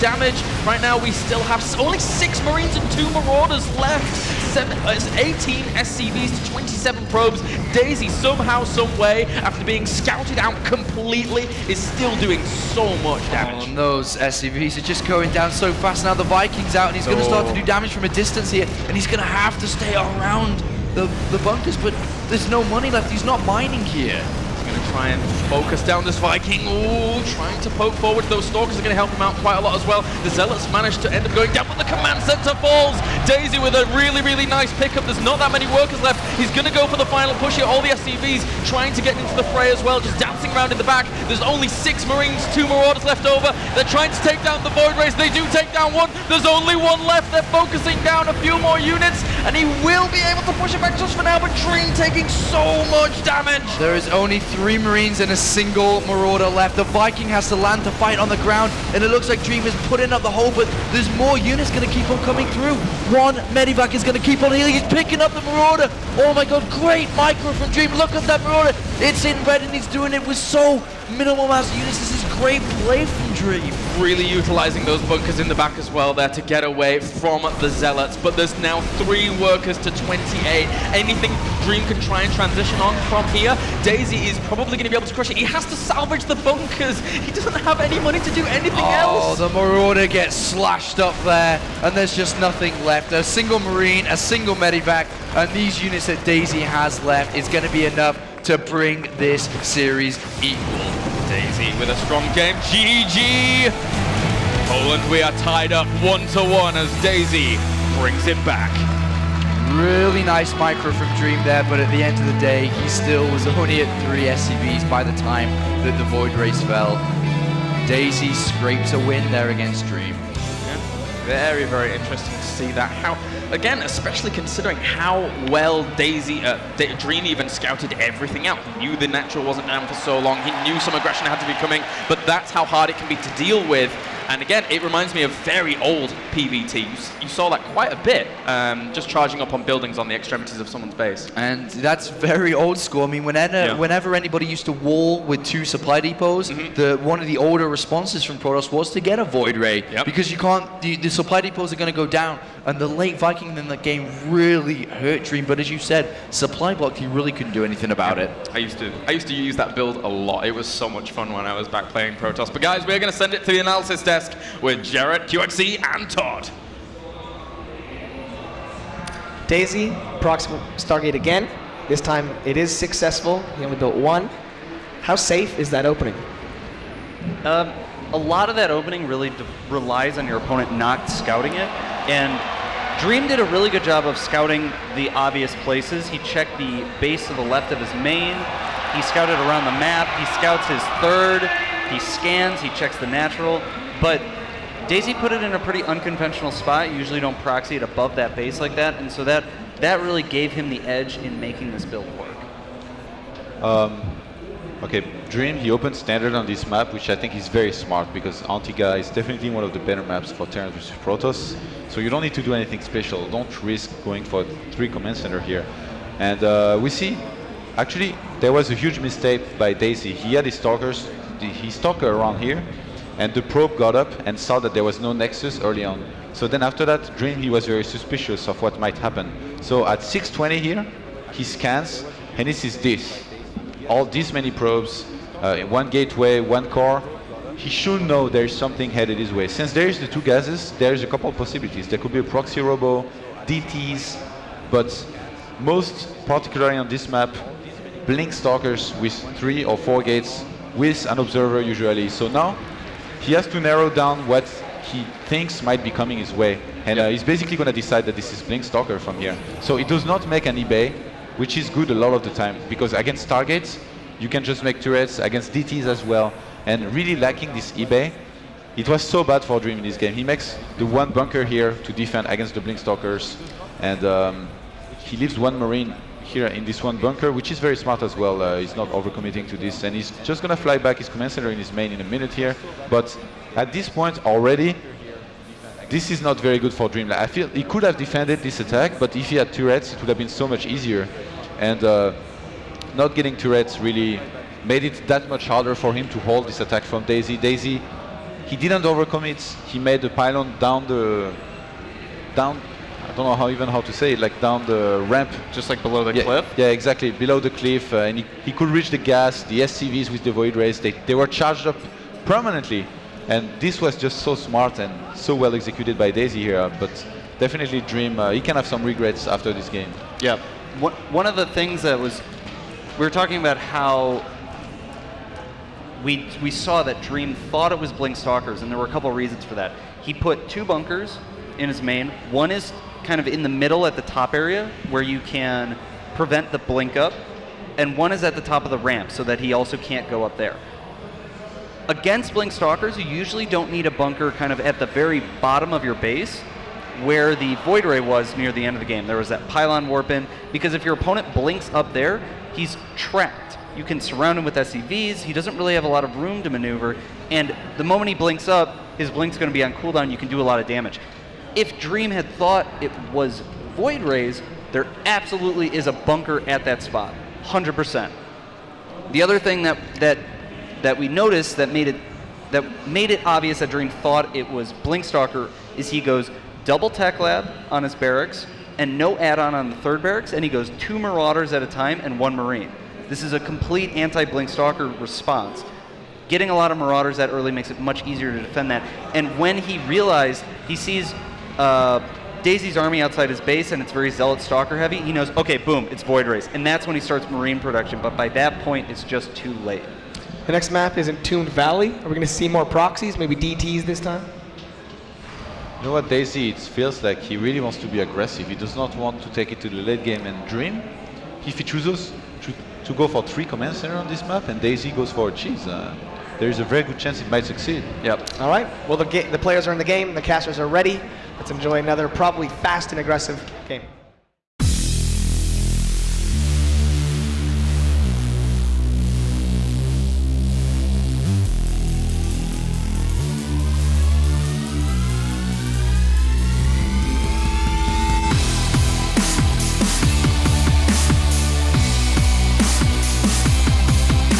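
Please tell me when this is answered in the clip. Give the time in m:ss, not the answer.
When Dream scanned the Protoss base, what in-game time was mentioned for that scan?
3:50.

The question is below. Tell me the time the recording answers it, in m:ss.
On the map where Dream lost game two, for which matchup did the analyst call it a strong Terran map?
3:28.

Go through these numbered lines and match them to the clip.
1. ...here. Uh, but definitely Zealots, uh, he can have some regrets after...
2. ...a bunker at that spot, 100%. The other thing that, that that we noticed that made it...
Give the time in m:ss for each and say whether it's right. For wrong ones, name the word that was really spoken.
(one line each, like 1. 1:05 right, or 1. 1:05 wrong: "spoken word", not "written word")
1. 5:16 wrong: "Dream", not "Zealots"
2. 6:05 right.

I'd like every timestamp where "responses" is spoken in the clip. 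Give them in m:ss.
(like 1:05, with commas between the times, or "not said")
2:27, 6:25.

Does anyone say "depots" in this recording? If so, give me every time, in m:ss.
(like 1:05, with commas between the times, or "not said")
2:26, 2:31.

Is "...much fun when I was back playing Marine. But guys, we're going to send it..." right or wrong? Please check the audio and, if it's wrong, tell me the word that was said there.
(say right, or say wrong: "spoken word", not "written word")
wrong: "Protoss", not "Marine".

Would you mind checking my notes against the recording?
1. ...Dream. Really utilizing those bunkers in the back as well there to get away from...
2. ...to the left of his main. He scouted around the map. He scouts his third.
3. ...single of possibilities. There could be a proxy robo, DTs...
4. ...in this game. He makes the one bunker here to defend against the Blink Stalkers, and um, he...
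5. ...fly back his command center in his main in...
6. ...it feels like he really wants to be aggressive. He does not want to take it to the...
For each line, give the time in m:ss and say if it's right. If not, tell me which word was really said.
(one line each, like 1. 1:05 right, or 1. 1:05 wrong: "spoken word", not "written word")
1. 1:13 right
2. 3:07 right
3. 4:01 wrong: "couple", not "single"
4. 4:29 right
5. 4:40 right
6. 6:46 right.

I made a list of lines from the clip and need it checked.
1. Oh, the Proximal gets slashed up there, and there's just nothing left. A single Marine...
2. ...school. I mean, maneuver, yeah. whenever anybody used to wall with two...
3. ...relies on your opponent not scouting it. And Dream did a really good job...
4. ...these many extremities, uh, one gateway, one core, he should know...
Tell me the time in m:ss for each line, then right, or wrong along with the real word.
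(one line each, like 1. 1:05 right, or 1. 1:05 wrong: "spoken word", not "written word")
1. 1:29 wrong: "Marauder", not "Proximal"
2. 2:22 wrong: "whenever", not "maneuver"
3. 2:59 right
4. 3:54 wrong: "probes", not "extremities".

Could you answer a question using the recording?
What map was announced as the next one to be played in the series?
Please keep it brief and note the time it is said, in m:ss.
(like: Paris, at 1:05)
Entombed Valley, at 6:41.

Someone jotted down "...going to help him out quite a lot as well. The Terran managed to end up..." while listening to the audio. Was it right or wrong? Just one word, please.
wrong.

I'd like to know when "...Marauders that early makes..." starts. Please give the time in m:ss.
6:26.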